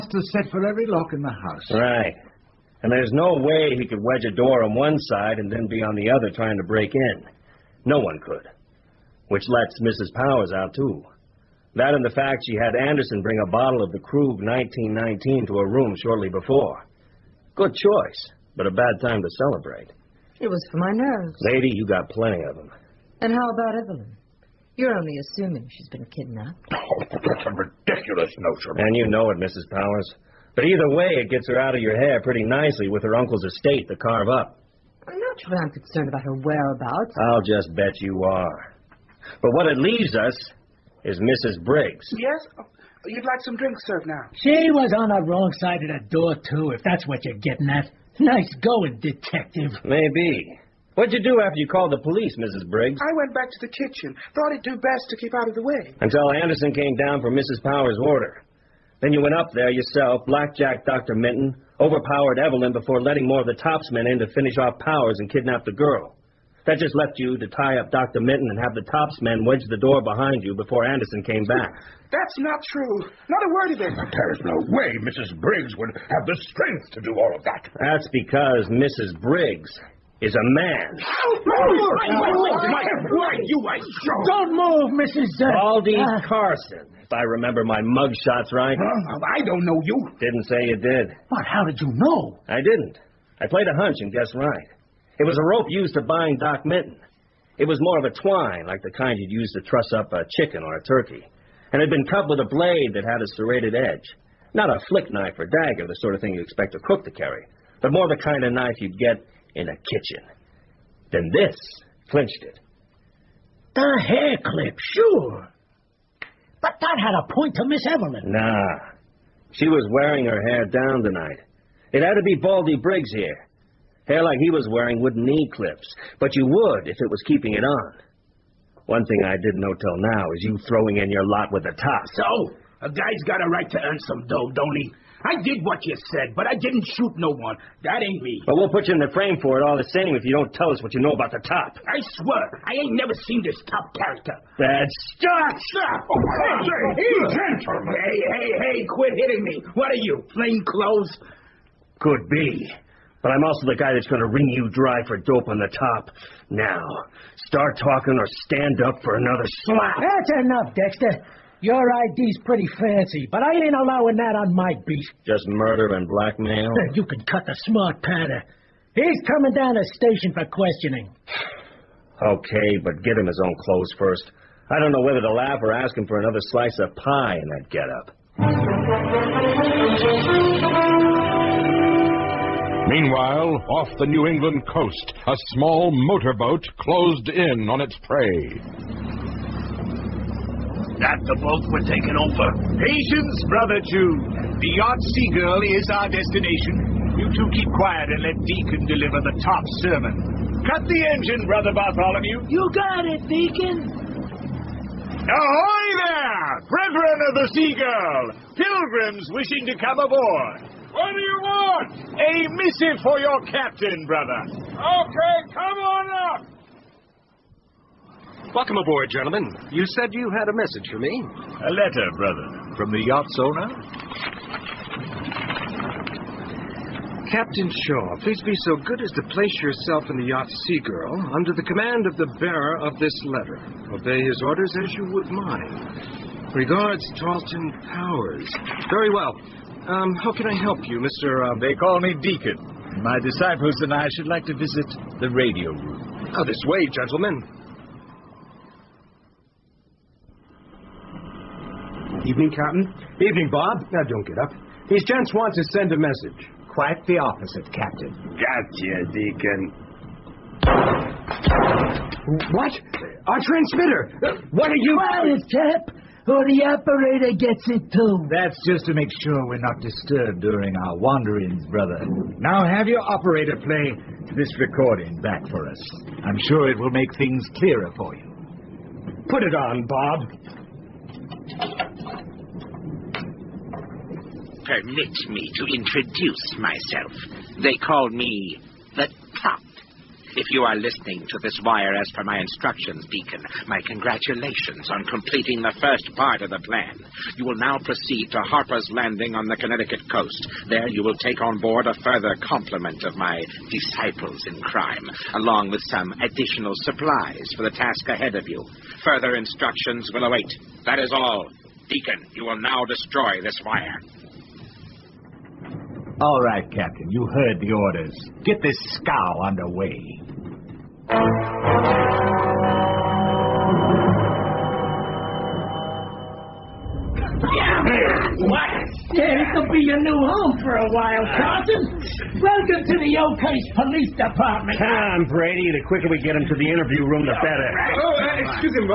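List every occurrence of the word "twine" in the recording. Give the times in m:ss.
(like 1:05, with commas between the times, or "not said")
1:38.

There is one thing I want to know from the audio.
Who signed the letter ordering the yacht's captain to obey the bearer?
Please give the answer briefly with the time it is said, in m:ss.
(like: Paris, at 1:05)
Tarleton Powers, at 3:57.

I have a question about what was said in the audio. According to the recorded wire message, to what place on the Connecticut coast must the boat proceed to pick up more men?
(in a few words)
Harper's Landing.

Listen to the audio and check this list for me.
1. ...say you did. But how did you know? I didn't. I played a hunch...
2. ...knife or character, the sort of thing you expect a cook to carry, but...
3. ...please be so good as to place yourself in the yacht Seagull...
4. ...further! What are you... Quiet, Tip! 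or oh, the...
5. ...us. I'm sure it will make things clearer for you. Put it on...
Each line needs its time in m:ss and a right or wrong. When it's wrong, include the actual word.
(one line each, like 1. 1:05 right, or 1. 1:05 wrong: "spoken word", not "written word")
1. 1:30 right
2. 1:45 wrong: "dagger", not "character"
3. 3:48 right
4. 4:23 wrong: "transmitter", not "further"
5. 4:35 right.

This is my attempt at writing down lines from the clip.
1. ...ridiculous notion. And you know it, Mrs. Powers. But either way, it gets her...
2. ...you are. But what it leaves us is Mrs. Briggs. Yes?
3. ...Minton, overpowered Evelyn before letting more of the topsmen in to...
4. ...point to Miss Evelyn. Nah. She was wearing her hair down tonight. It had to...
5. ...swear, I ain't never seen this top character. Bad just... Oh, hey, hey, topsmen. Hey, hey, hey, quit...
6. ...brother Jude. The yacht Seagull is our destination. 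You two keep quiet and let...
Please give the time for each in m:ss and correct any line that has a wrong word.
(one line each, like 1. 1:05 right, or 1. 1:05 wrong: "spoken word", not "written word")
1. 0:27 right
2. 0:38 right
3. 1:01 right
4. 1:57 right
5. 2:22 wrong: "gentlemen", not "topsmen"
6. 3:13 right.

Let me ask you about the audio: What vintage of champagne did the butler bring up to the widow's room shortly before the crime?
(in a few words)
Krug 1919.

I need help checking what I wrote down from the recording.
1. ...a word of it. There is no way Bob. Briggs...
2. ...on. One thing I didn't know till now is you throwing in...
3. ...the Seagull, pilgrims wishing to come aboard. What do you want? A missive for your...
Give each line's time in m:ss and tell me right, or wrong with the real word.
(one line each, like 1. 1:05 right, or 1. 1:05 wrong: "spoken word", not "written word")
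1. 1:13 wrong: "Mrs", not "Bob"
2. 2:07 right
3. 3:27 right.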